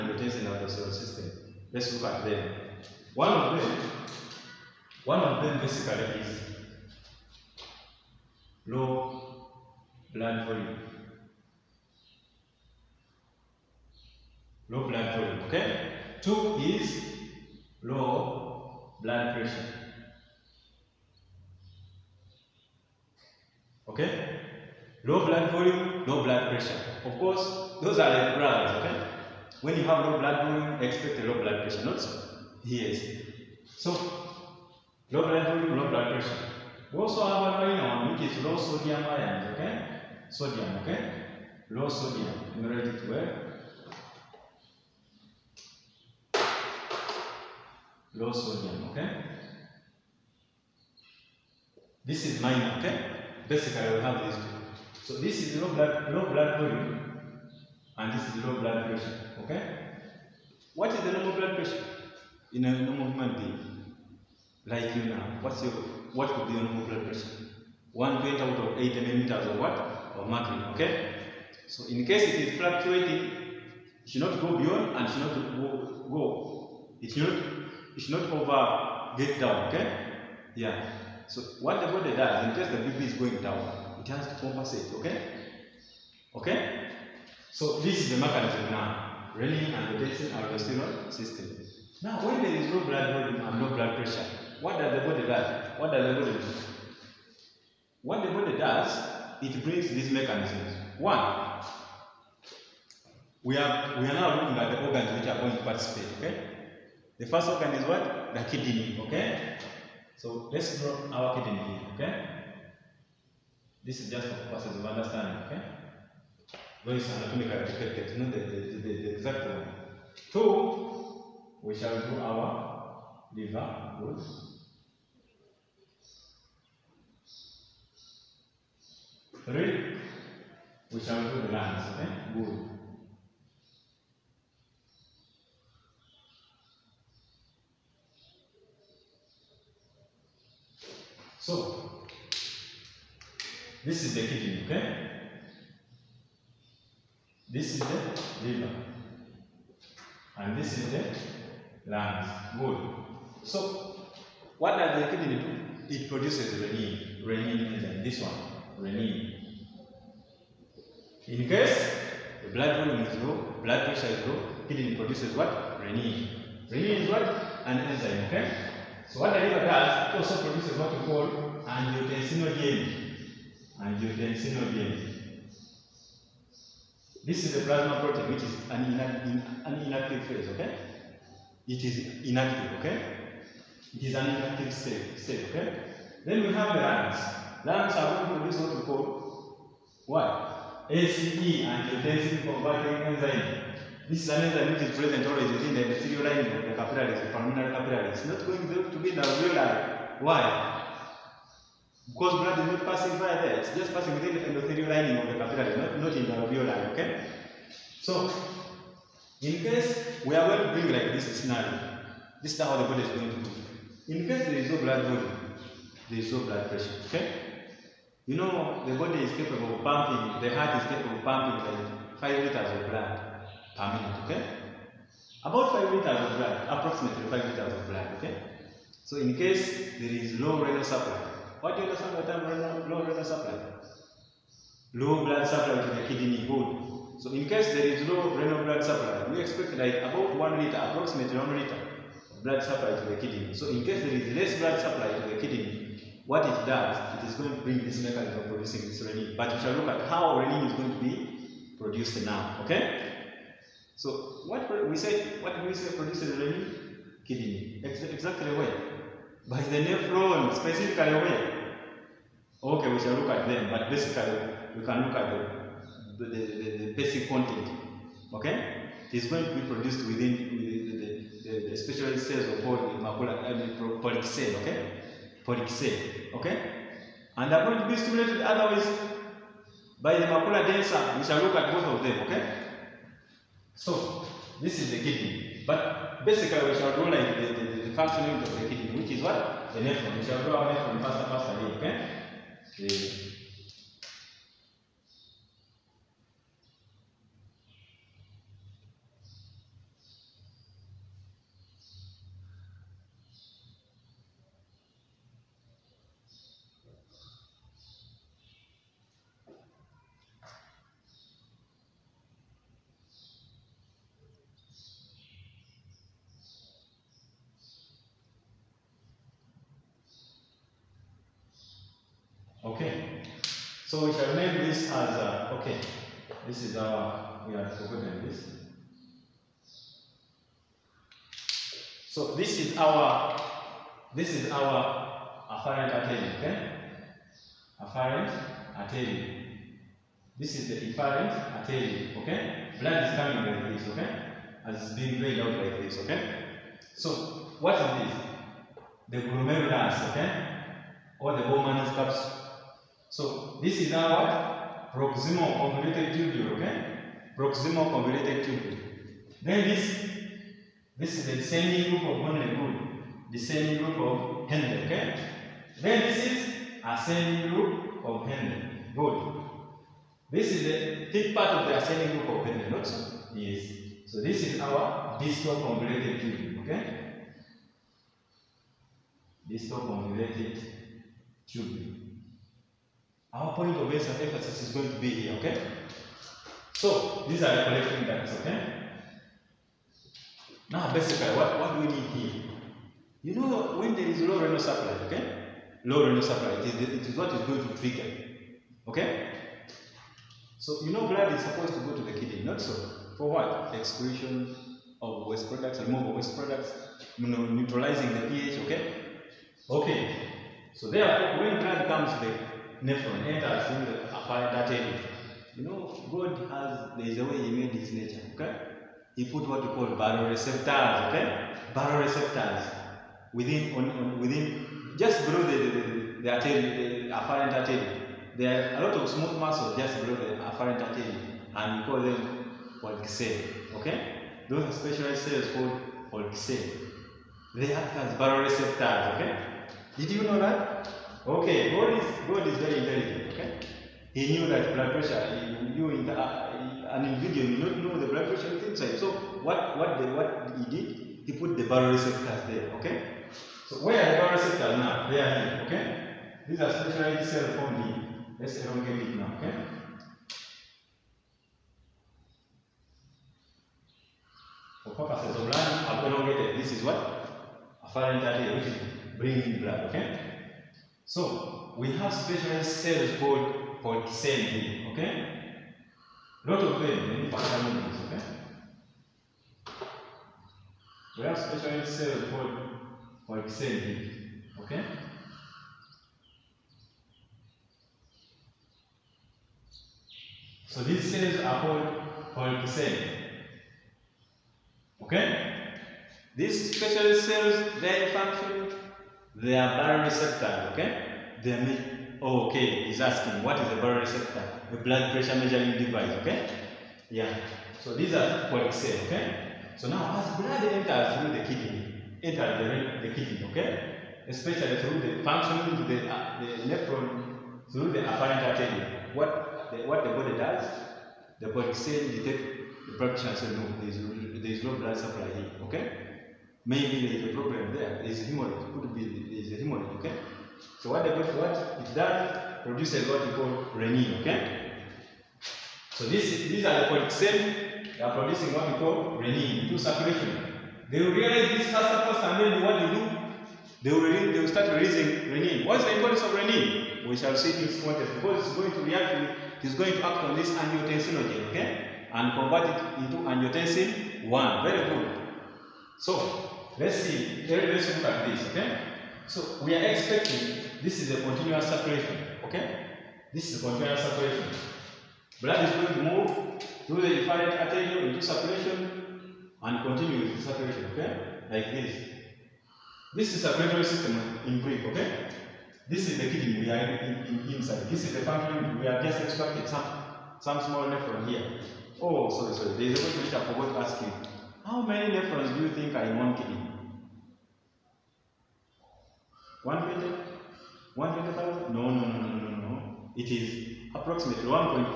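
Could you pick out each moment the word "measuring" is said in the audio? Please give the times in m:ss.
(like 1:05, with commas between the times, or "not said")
8:25.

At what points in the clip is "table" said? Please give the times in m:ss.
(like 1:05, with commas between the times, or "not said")
not said.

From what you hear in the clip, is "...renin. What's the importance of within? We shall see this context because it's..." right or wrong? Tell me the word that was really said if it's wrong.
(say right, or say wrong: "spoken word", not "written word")
wrong: "renin", not "within".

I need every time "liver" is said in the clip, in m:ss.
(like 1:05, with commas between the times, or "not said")
2:03, 2:28, 2:49.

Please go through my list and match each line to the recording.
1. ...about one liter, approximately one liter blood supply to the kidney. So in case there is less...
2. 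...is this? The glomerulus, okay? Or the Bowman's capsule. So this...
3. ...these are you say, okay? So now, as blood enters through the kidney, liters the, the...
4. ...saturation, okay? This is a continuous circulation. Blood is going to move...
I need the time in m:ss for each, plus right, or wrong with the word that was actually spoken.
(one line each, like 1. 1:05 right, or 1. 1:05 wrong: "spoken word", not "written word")
1. 3:59 right
2. 5:47 right
3. 8:27 wrong: "enters", not "liters"
4. 9:21 wrong: "circulation", not "saturation".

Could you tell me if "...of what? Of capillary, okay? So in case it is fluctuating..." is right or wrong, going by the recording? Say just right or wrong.
wrong.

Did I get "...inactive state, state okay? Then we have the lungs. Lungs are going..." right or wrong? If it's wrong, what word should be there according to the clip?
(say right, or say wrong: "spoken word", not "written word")
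right.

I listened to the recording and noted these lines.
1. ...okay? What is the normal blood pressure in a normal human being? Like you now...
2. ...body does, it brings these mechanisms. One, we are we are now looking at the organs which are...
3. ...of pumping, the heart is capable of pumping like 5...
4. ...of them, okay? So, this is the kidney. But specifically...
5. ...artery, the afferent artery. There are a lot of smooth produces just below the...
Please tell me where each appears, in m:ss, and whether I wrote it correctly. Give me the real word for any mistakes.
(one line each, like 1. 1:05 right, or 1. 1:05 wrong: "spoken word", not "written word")
1. 0:59 right
2. 1:38 right
3. 3:39 right
4. 4:41 wrong: "basically", not "specifically"
5. 7:06 wrong: "muscles", not "produces".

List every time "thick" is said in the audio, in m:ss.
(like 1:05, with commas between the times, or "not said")
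6:11.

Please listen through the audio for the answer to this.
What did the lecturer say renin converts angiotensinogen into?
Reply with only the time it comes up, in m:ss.
9:13.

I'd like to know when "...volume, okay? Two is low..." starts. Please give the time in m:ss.
0:15.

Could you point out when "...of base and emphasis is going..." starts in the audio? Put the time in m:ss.
6:23.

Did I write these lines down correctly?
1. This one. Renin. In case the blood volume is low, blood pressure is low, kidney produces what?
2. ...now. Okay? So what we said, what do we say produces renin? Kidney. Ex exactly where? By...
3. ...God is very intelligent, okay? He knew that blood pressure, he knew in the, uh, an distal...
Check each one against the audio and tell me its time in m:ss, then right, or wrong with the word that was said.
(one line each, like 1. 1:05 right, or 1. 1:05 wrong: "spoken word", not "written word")
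1. 2:38 right
2. 4:12 right
3. 7:22 wrong: "individual", not "distal".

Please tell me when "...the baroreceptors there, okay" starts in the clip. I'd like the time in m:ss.
7:31.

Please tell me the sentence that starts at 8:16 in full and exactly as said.
These specialized cells, they function they are baroreceptor, okay?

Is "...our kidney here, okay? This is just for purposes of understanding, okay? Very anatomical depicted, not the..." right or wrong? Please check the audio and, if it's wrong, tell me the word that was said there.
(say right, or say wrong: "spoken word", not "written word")
right.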